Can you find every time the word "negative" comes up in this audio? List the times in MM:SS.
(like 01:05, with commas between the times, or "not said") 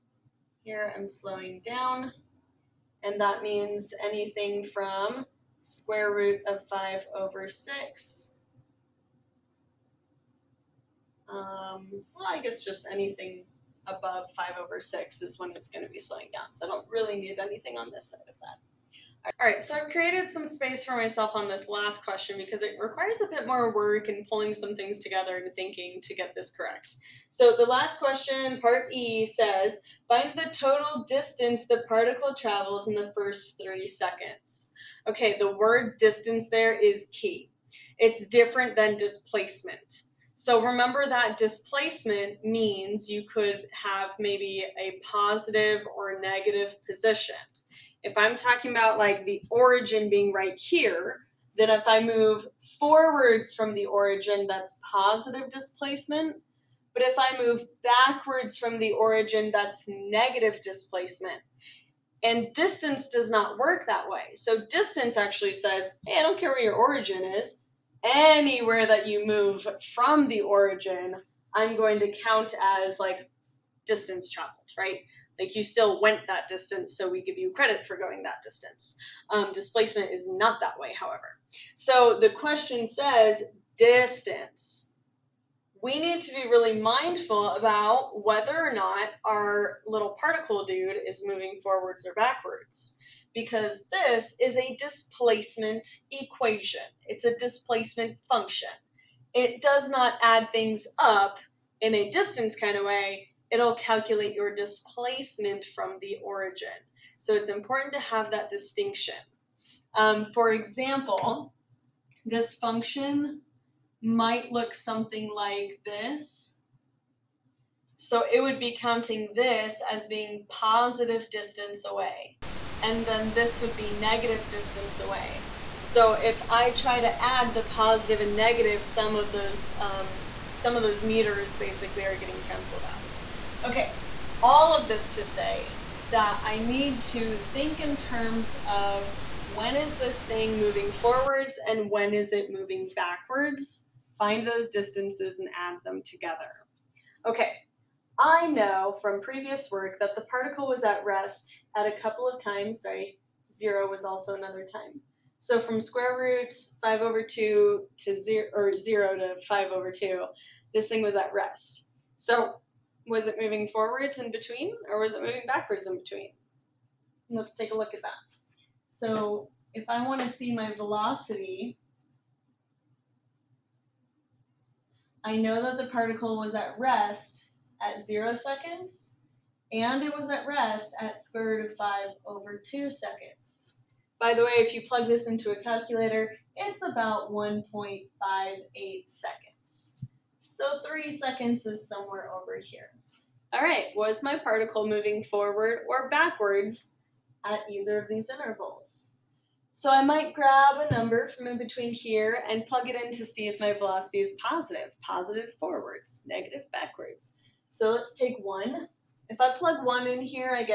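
00:46, 00:59, 02:03, 02:08, 03:26.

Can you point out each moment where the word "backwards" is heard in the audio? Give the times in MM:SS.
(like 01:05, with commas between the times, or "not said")
00:57, 01:32, 02:22, 02:45, 03:16, 03:26.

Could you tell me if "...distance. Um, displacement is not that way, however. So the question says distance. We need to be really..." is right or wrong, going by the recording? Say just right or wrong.
right.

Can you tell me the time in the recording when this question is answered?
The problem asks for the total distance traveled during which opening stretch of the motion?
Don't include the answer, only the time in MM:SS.
00:33.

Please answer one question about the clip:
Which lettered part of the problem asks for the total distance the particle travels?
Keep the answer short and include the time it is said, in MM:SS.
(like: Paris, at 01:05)
Part E, at 00:28.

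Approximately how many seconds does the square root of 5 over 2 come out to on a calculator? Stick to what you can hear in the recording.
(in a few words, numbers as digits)
1.58.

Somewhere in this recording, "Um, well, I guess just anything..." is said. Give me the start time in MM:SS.
00:11.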